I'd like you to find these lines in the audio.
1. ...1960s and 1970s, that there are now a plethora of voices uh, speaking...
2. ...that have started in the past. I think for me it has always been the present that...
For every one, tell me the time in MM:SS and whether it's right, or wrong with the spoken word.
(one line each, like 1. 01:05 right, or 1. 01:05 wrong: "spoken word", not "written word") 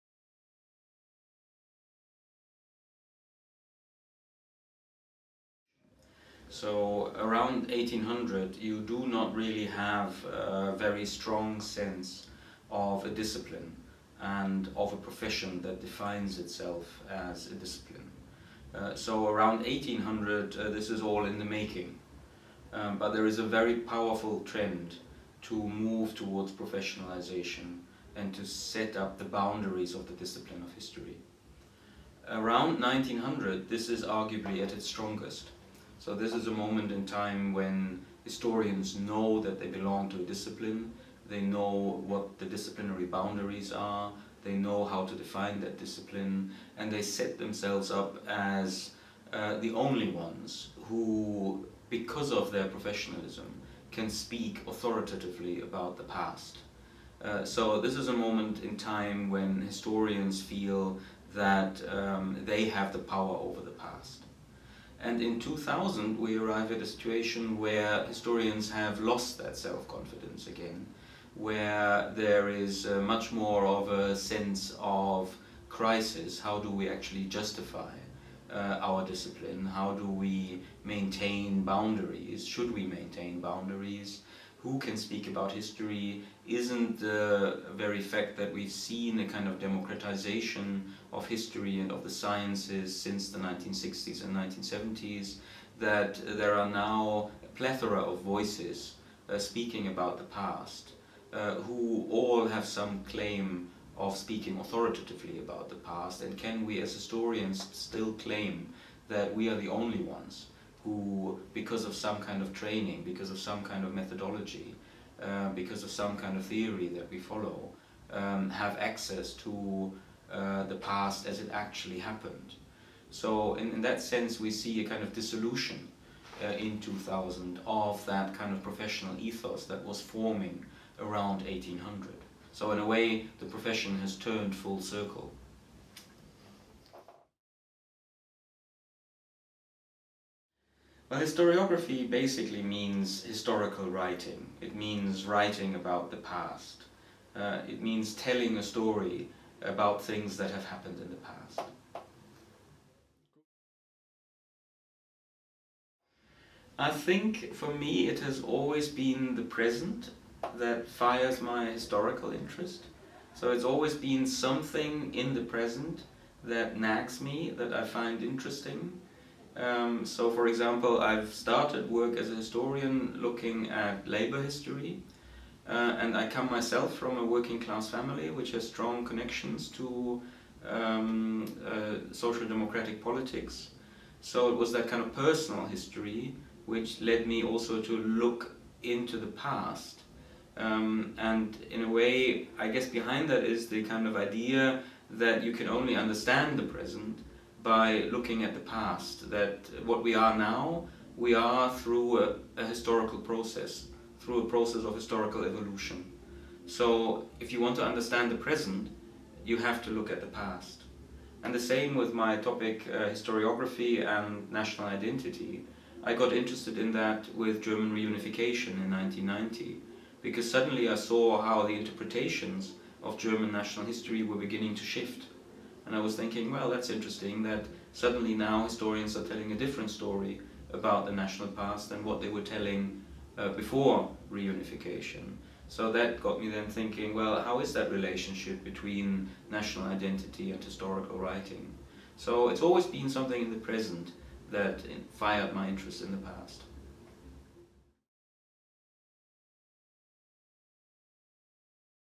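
1. 01:33 right
2. 02:30 wrong: "happened", not "started".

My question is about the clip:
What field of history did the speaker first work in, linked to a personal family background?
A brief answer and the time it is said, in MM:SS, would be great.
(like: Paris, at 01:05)
Labor history, at 02:54.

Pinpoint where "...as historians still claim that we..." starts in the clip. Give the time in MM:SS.
01:46.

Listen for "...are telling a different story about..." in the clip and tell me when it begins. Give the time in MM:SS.
03:49.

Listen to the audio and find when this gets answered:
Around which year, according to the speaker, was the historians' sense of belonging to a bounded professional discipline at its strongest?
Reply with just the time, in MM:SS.
00:32.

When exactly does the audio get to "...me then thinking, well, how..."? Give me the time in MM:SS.
03:56.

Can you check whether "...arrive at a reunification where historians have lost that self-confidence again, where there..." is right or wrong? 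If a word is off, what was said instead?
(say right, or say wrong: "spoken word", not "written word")
wrong: "situation", not "reunification".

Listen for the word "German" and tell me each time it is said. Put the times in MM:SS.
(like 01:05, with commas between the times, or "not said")
03:37, 03:43.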